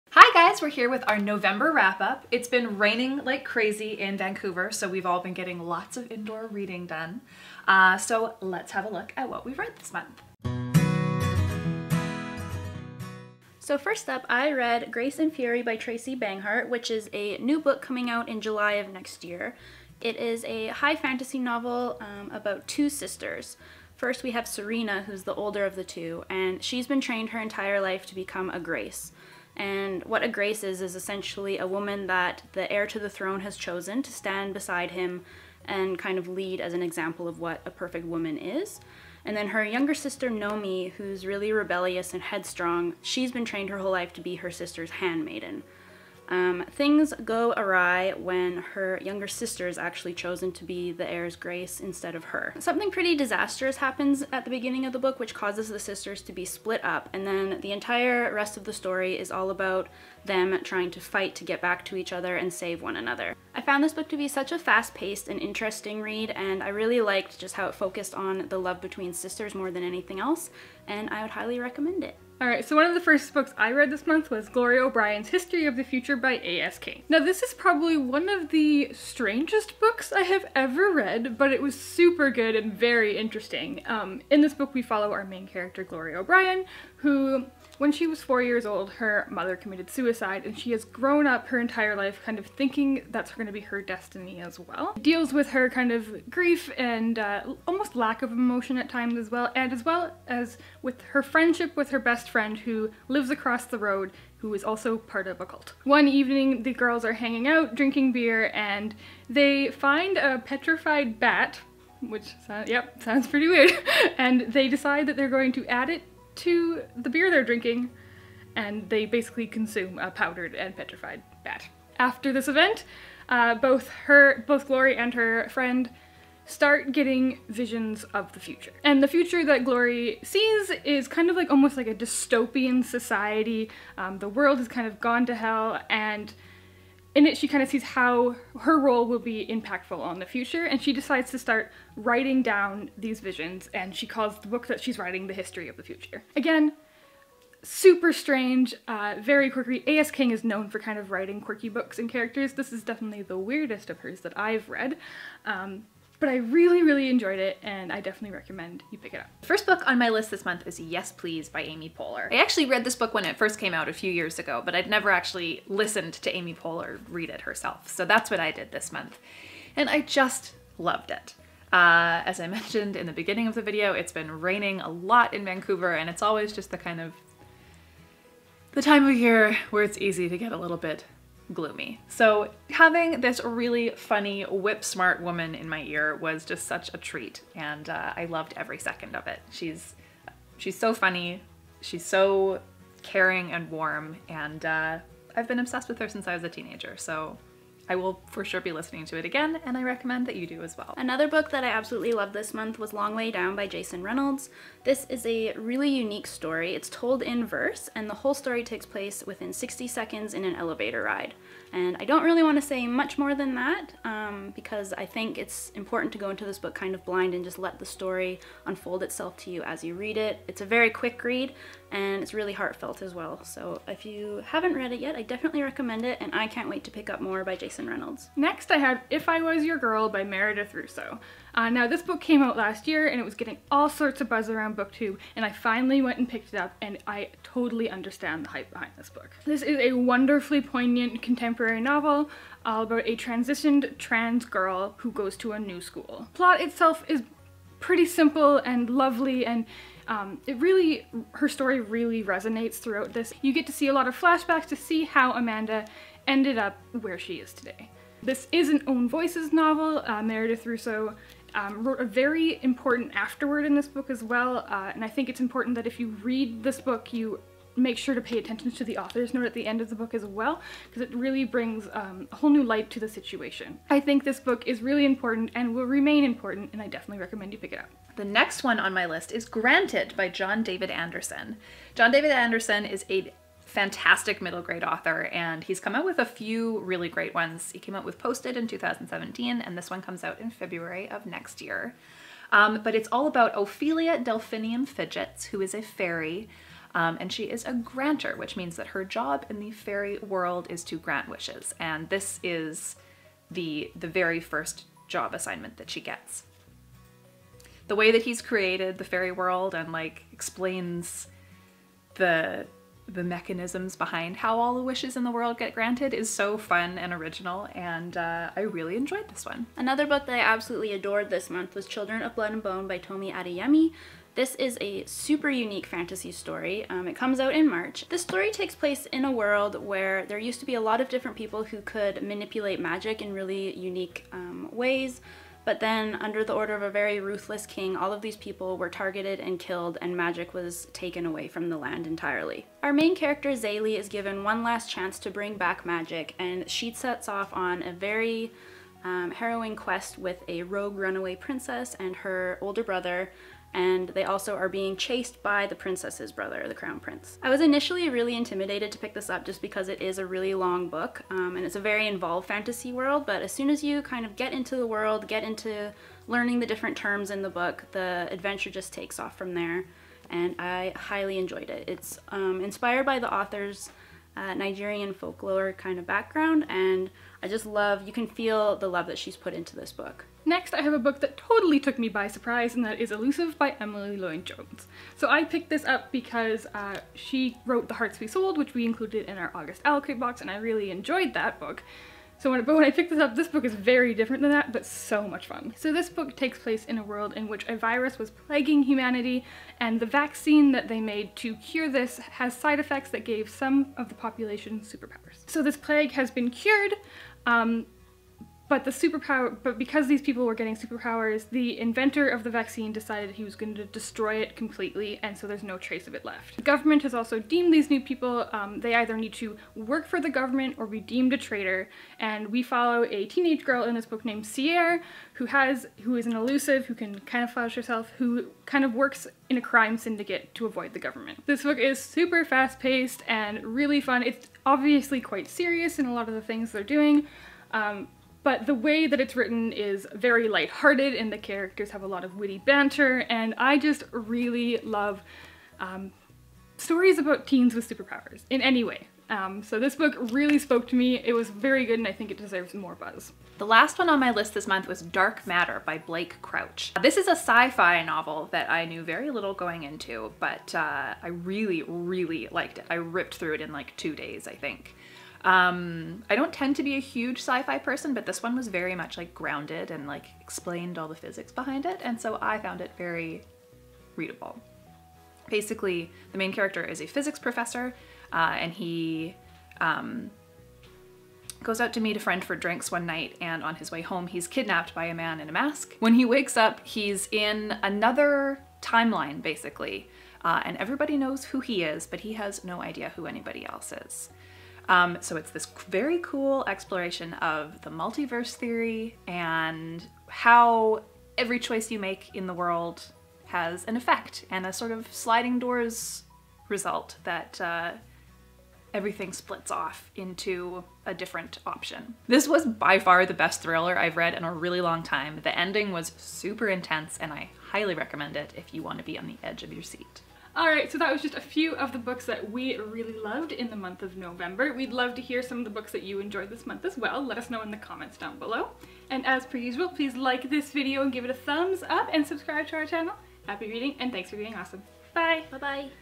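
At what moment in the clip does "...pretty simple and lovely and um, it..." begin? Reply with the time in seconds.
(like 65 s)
247 s.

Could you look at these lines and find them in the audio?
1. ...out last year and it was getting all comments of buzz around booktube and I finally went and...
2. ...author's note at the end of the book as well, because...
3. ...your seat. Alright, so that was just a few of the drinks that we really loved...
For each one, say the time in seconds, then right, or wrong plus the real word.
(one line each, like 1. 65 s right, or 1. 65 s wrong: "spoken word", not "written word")
1. 232 s wrong: "sorts", not "comments"
2. 268 s right
3. 519 s wrong: "books", not "drinks".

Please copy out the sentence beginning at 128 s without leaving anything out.
And the future that Glory sees is kind of like almost like a dystopian society.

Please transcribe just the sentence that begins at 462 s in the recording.
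I ripped through it in like two days, I think.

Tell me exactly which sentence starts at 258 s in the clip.
This is an own voices novel.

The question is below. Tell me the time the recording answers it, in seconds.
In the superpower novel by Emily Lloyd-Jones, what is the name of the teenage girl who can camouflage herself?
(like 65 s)
424 s.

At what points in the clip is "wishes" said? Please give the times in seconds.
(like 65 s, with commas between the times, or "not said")
301 s, 314 s.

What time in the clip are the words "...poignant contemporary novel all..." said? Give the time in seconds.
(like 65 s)
240 s.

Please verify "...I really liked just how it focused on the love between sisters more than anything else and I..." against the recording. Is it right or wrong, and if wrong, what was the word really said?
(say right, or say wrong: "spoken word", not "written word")
right.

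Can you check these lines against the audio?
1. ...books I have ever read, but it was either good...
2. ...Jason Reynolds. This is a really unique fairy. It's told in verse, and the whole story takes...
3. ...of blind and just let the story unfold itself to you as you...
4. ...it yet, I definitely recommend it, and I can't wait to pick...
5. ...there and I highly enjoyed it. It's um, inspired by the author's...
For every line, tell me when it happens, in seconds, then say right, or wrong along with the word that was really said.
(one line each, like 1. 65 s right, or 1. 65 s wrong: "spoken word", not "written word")
1. 79 s wrong: "super", not "either"
2. 203 s wrong: "story", not "fairy"
3. 216 s right
4. 224 s right
5. 369 s right.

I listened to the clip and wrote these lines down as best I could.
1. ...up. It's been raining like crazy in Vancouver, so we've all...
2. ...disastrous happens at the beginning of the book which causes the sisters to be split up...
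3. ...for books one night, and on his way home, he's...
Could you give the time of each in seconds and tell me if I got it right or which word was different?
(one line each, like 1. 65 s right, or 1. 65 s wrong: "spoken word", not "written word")
1. 2 s right
2. 53 s right
3. 482 s wrong: "drinks", not "books".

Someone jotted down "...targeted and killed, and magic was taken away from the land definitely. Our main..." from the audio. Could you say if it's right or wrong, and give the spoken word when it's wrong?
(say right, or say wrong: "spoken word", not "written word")
wrong: "entirely", not "definitely".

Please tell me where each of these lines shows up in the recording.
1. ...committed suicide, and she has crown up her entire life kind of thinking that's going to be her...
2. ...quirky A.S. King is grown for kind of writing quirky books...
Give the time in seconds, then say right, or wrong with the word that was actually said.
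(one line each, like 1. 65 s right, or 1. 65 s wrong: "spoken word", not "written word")
1. 89 s wrong: "grown", not "crown"
2. 149 s wrong: "known", not "grown".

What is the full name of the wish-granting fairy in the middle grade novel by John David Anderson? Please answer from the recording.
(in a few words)
Ophelia Delphinium Fidgets.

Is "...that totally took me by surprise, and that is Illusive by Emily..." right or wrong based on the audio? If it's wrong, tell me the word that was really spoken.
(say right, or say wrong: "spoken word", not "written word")
right.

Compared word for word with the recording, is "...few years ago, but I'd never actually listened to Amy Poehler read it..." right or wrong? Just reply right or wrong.
right.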